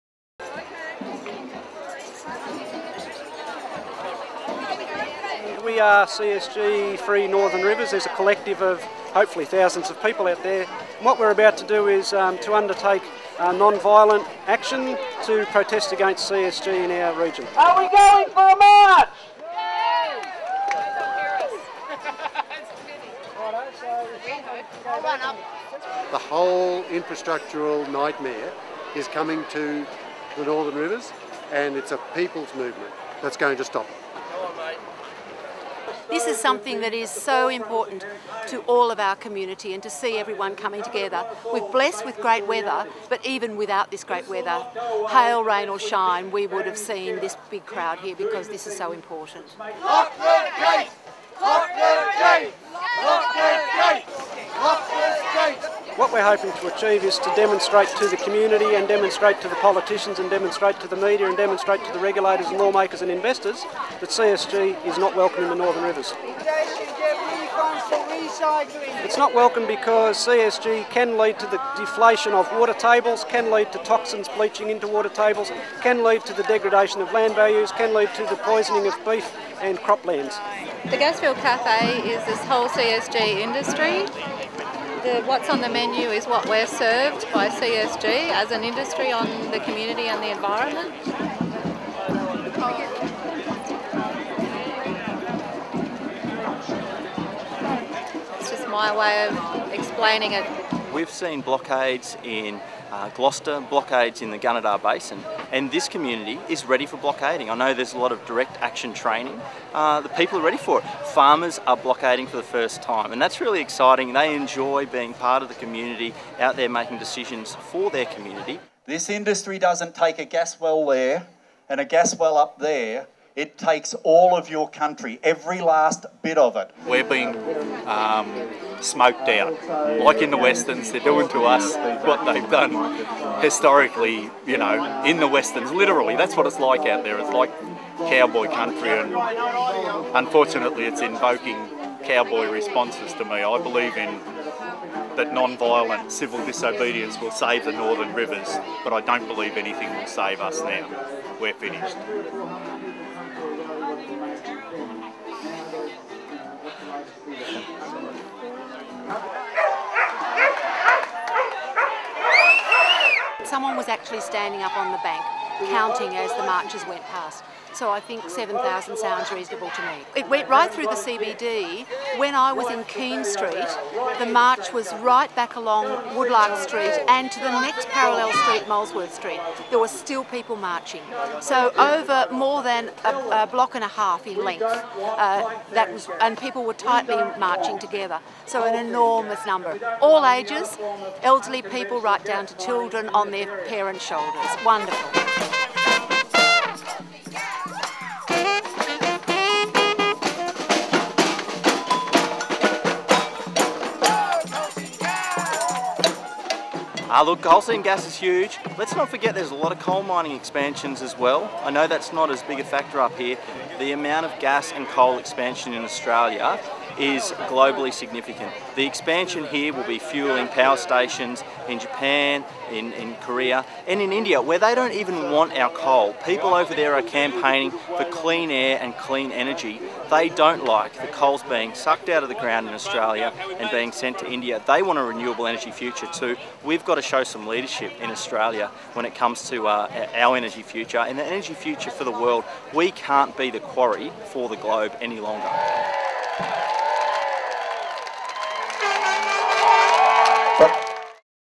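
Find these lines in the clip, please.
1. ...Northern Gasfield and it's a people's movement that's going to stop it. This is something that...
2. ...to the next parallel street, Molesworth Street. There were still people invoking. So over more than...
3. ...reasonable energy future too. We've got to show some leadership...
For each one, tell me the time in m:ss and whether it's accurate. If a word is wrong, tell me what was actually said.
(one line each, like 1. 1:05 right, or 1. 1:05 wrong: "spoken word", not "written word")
1. 0:30 wrong: "Rivers", not "Gasfield"
2. 2:57 wrong: "marching", not "invoking"
3. 3:55 wrong: "renewable", not "reasonable".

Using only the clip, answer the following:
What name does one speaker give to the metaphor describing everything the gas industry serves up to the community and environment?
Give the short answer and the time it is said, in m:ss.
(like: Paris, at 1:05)
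The Gasfield Cafe, at 1:20.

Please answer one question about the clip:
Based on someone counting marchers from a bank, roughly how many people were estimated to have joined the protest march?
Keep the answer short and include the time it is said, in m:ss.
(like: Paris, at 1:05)
7,000, at 2:48.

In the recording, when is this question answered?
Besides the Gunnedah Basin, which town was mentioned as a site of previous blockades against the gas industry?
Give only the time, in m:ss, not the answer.
1:43.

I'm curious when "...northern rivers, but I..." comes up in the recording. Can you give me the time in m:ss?
2:27.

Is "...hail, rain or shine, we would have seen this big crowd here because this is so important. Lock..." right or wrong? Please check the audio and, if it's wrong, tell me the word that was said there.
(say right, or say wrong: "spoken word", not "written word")
right.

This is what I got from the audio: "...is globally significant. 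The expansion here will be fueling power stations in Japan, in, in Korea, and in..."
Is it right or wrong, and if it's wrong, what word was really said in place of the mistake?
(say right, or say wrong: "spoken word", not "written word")
right.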